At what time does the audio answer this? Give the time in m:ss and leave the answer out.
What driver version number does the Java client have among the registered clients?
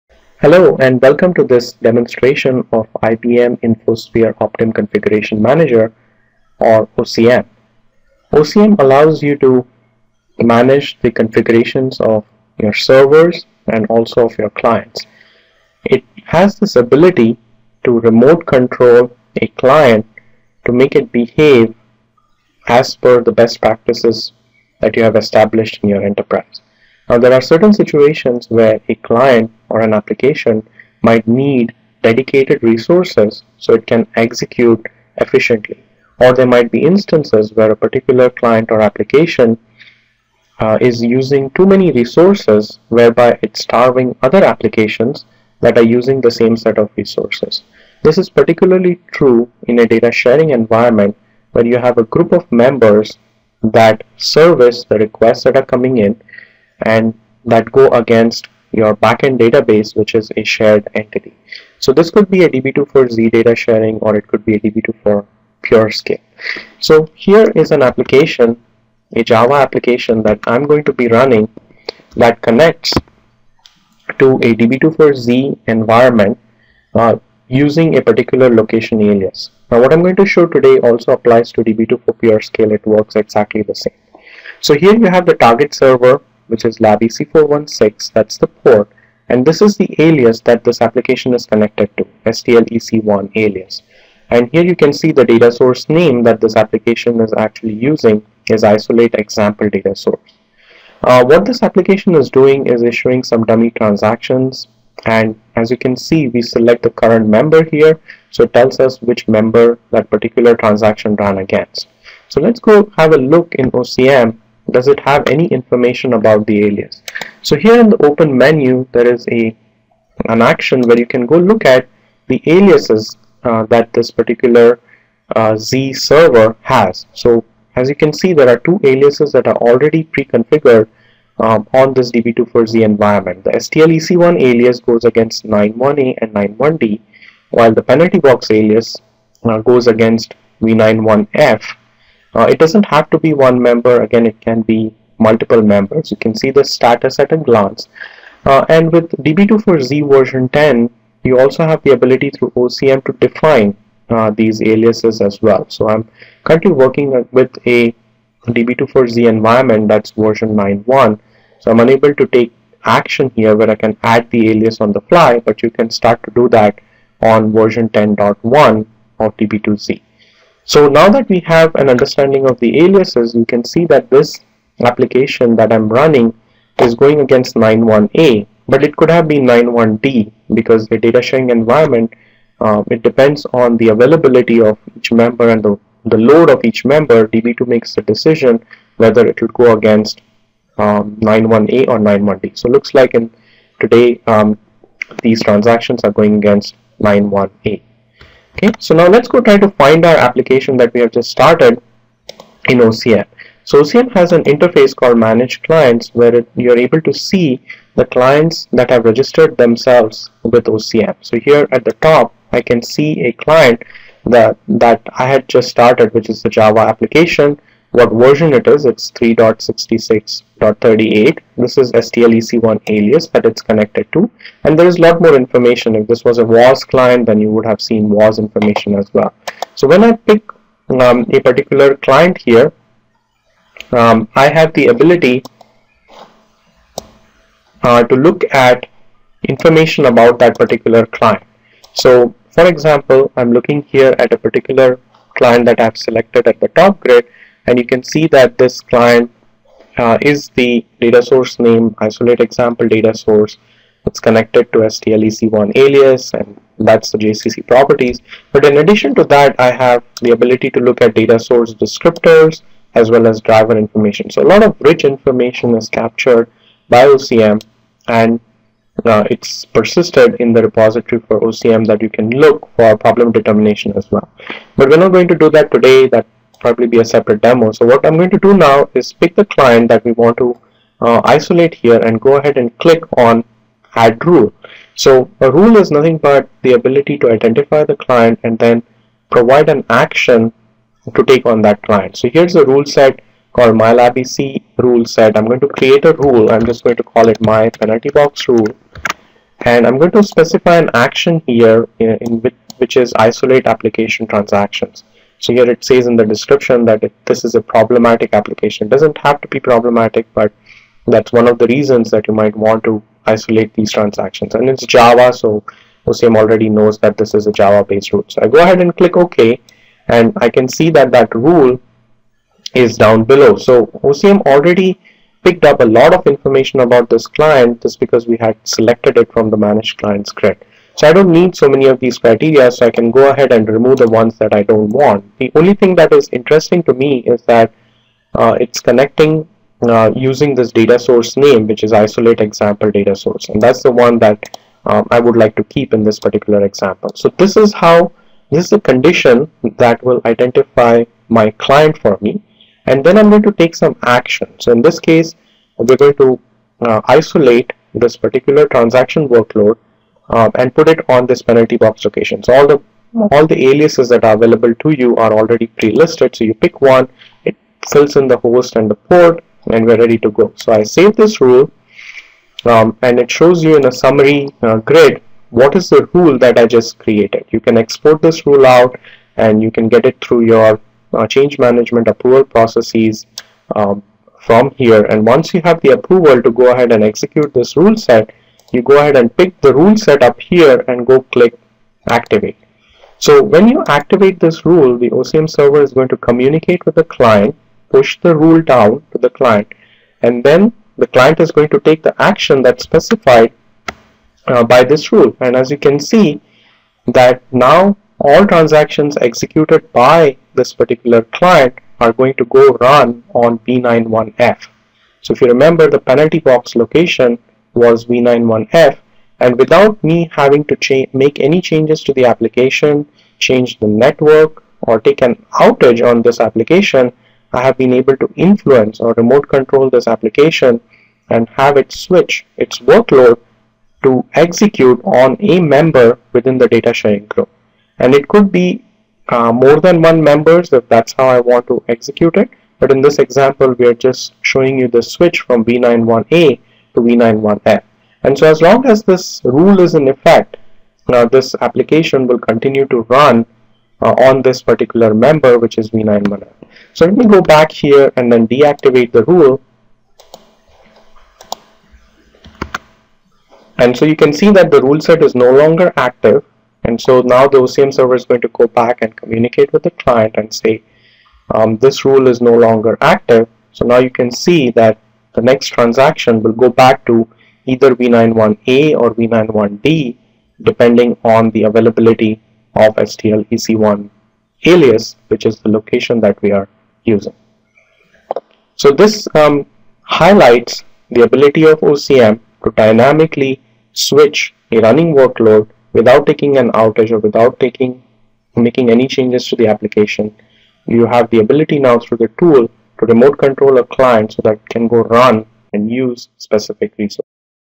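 3:39.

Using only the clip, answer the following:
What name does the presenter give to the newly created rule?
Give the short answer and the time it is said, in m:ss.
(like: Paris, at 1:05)
my penalty box rule, at 4:57.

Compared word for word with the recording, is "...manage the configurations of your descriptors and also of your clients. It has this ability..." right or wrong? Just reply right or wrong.
wrong.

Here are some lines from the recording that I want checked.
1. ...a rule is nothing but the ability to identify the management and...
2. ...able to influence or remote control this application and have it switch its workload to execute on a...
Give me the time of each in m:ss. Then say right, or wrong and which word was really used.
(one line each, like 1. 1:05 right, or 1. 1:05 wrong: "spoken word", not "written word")
1. 4:45 wrong: "client", not "management"
2. 7:07 right.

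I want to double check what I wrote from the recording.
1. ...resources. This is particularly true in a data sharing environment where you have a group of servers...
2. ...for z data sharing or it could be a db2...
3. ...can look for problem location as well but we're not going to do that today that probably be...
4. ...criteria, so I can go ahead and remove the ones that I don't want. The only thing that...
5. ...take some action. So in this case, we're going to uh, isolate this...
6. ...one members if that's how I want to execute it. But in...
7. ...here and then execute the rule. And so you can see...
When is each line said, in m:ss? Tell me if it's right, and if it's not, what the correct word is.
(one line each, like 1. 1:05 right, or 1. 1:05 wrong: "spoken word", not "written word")
1. 0:46 wrong: "members", not "servers"
2. 1:02 right
3. 4:32 wrong: "determination", not "location"
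4. 5:32 right
5. 5:53 right
6. 7:20 right
7. 7:37 wrong: "deactivate", not "execute".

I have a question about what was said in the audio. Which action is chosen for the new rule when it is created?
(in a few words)
isolate application transactions.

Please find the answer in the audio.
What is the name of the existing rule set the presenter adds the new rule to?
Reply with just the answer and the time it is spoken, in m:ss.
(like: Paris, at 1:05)
MyLabEC rule set, at 4:53.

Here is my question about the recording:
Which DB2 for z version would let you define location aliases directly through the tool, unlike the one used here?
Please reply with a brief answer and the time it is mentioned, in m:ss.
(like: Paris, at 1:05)
version 10, at 2:30.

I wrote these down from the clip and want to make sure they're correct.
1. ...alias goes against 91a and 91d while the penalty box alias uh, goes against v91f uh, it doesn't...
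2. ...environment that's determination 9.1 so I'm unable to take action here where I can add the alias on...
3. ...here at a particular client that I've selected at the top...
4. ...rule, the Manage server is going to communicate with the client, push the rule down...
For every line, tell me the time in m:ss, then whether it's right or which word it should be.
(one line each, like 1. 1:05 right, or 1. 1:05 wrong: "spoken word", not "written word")
1. 2:14 right
2. 2:39 wrong: "version", not "determination"
3. 4:03 right
4. 6:34 wrong: "OCM", not "Manage".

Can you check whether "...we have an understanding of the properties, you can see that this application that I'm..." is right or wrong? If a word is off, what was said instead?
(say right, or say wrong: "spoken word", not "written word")
wrong: "aliases", not "properties".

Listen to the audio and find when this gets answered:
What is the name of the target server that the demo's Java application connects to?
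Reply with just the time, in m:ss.
1:26.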